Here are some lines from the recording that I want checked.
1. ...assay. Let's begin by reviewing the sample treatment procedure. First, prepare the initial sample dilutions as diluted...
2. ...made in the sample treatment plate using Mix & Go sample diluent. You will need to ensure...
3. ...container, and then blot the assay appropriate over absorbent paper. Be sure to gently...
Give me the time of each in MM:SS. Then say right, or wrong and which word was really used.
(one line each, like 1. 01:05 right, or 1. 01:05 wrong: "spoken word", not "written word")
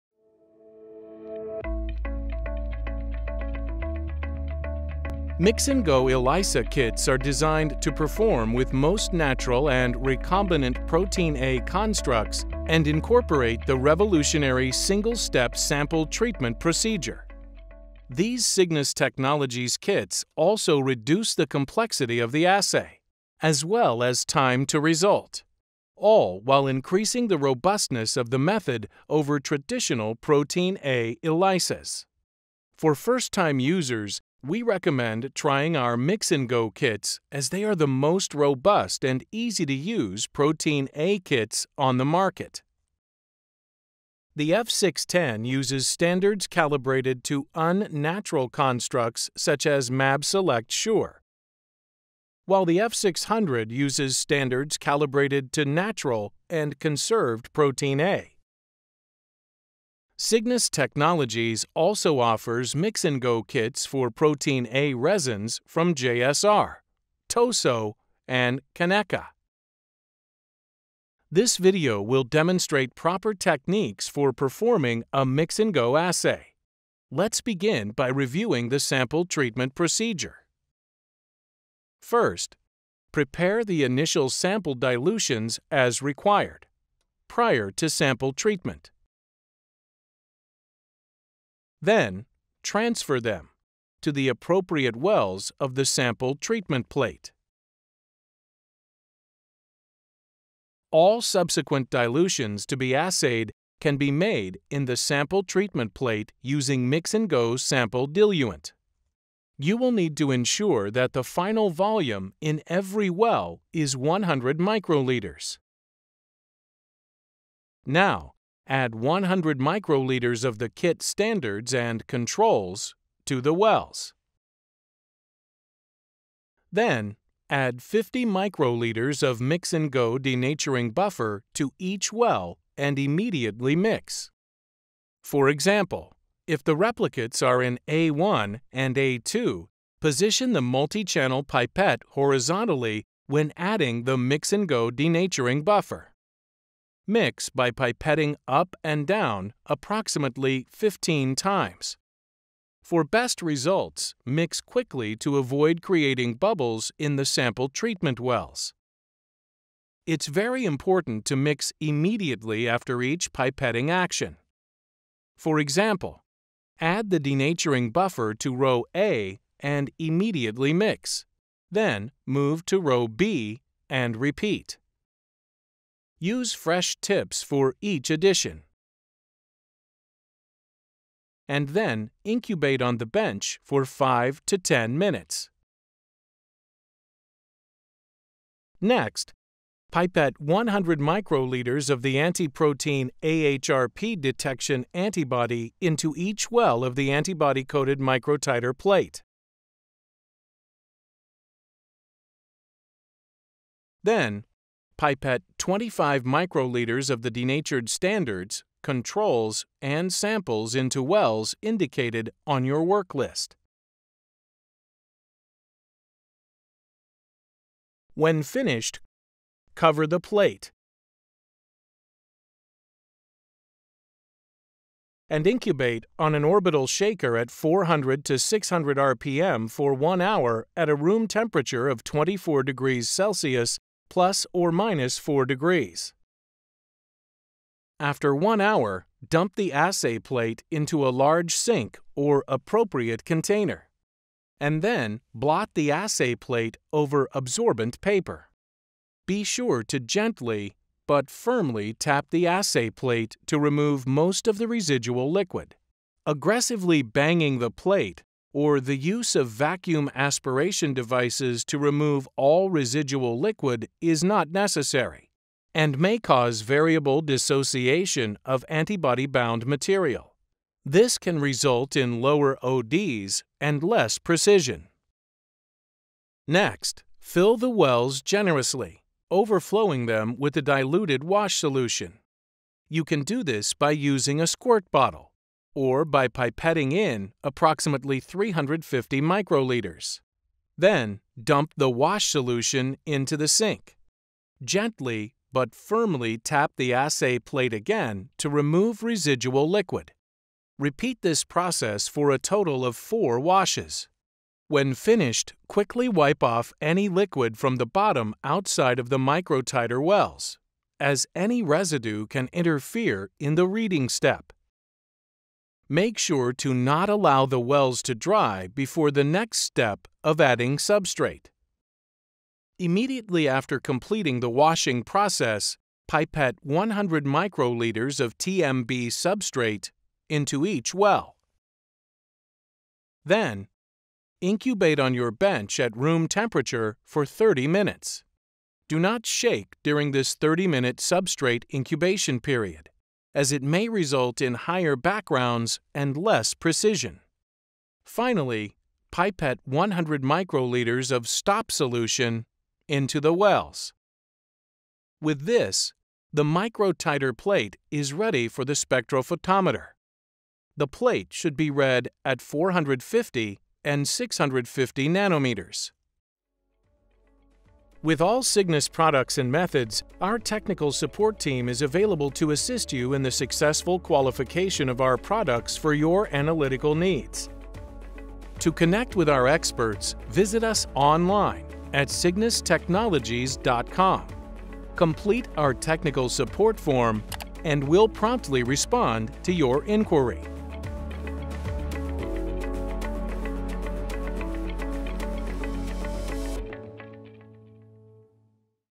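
1. 01:15 wrong: "required", not "diluted"
2. 01:44 right
3. 04:03 wrong: "plate", not "appropriate".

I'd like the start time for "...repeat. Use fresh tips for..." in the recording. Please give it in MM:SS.
02:54.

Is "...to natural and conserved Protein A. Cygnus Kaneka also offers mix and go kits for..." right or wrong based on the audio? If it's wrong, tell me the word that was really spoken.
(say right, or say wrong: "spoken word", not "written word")
wrong: "Technologies", not "Kaneka".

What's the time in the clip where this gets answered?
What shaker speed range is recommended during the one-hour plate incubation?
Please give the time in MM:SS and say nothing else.
03:47.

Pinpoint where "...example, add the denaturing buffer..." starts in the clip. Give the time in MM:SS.
02:45.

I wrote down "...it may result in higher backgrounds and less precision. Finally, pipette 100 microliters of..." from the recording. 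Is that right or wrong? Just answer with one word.
right.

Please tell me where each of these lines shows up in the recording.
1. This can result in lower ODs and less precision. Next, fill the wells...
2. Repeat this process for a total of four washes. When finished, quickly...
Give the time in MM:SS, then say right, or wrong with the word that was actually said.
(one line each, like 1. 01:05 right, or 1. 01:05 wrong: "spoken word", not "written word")
1. 04:30 right
2. 05:00 right.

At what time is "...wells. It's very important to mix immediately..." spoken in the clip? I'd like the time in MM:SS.
02:38.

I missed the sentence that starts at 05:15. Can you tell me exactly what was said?
Make sure to not allow the wells to dry before the next step of adding substrate.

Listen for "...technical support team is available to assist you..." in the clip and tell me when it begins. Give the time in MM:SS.
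06:10.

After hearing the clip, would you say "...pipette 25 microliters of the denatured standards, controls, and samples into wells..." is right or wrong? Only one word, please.
right.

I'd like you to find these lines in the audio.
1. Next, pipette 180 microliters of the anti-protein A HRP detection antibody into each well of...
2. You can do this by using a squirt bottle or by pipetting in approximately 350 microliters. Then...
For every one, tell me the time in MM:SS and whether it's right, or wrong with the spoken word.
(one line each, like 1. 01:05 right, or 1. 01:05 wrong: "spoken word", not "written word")
1. 03:08 wrong: "100", not "180"
2. 04:42 right.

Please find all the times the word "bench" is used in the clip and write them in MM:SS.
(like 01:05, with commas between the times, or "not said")
03:03, 05:35.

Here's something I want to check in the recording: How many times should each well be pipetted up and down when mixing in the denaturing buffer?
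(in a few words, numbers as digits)
15.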